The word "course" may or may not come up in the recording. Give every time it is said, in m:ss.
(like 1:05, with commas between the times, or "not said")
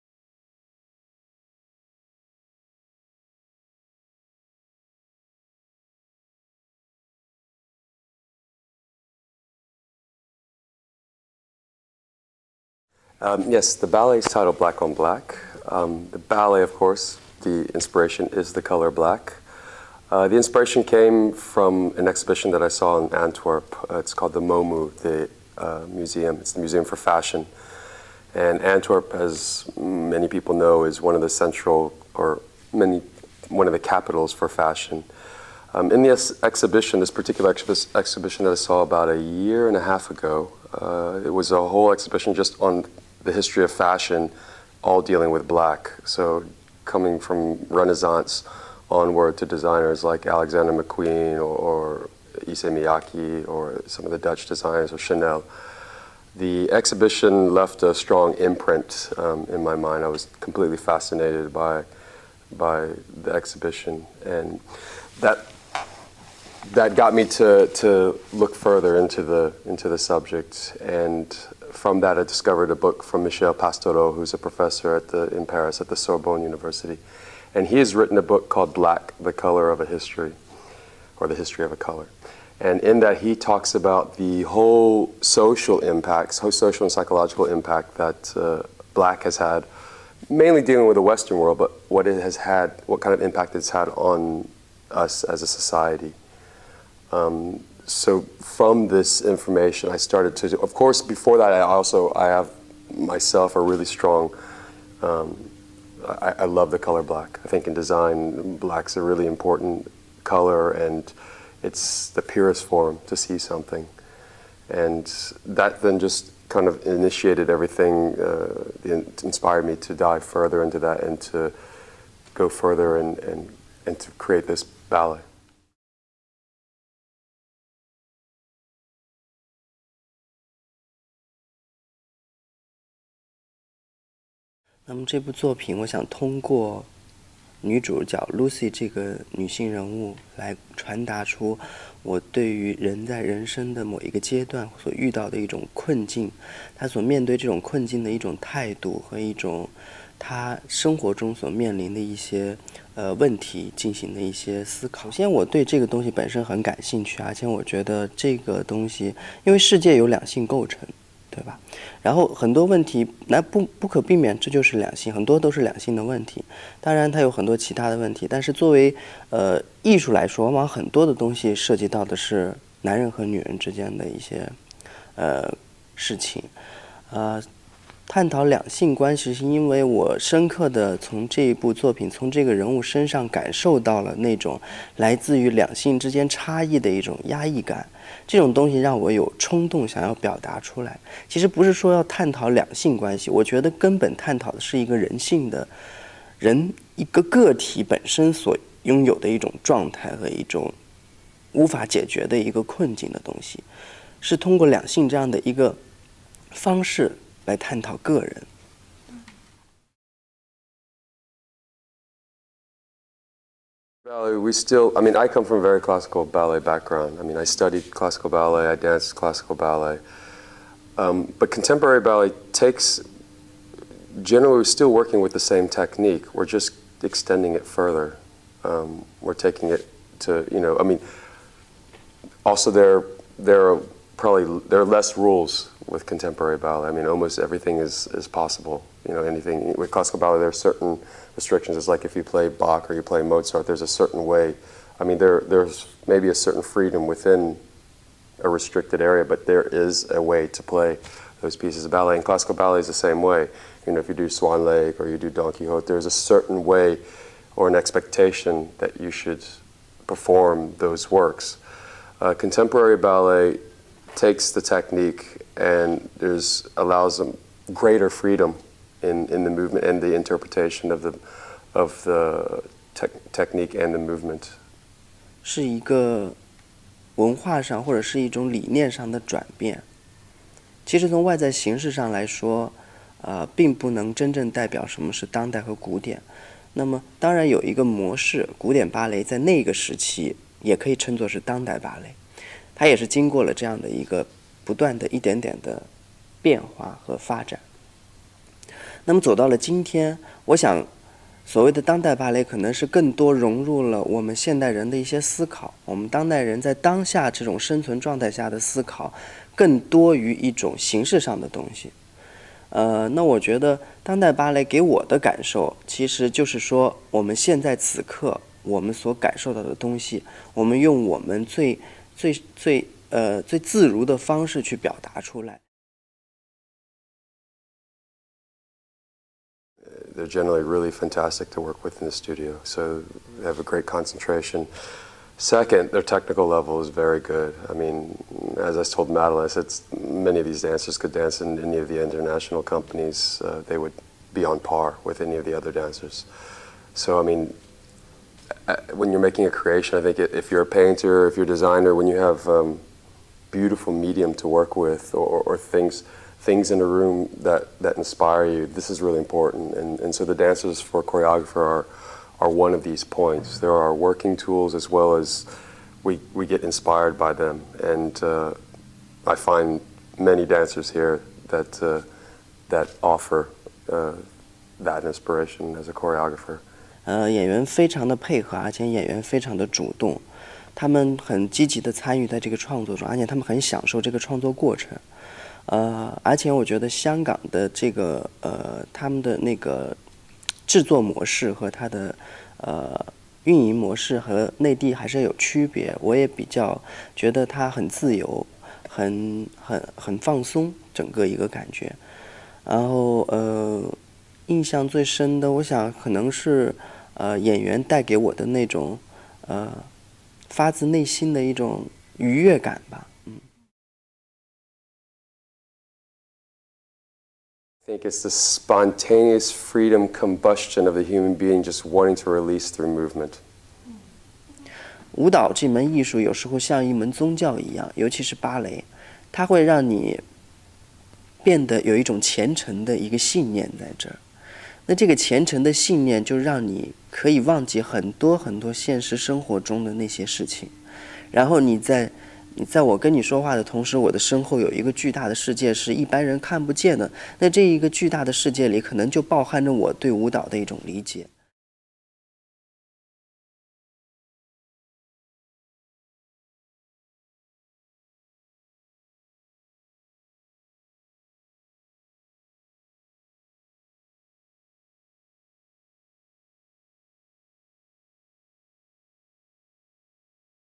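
0:16, 1:40.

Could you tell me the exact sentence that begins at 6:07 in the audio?
And uh, I find many dancers here that, uh, that offer uh, that inspiration as a choreographer.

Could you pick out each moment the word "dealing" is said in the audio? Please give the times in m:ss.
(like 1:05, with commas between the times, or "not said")
0:45, 1:30.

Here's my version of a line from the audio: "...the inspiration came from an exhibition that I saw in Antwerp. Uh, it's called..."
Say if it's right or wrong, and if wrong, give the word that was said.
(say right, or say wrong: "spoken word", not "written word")
right.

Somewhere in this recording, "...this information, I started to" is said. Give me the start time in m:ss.
1:38.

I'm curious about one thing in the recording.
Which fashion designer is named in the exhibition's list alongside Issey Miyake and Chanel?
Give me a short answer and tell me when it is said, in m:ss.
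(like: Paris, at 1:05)
Alexander McQueen, at 0:50.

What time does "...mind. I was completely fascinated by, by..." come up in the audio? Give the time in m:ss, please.
0:59.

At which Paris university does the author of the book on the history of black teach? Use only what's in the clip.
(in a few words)
Sorbonne.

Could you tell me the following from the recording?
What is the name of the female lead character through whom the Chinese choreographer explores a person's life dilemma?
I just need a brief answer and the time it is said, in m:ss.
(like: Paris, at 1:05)
Lucy, at 2:18.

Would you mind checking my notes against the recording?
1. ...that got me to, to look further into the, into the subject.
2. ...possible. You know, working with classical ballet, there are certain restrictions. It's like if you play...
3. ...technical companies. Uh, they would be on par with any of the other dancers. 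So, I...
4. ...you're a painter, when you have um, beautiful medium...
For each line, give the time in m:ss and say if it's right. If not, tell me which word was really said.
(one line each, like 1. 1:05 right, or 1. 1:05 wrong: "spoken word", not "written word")
1. 1:06 right
2. 3:58 wrong: "anything", not "working"
3. 5:42 wrong: "international", not "technical"
4. 5:51 wrong: "designer", not "painter".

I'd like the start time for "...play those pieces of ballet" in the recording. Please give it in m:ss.
4:10.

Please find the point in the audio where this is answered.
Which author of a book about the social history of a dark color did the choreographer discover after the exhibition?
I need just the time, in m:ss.
1:13.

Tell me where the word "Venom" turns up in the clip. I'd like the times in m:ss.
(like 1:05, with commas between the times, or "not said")
not said.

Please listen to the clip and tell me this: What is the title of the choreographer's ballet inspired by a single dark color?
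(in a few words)
Black on Black.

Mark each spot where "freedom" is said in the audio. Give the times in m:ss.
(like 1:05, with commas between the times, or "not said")
4:06, 4:28, 6:59.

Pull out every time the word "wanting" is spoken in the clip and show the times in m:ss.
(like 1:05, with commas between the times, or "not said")
7:01.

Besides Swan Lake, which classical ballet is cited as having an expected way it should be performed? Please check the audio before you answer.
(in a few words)
Don Quixote.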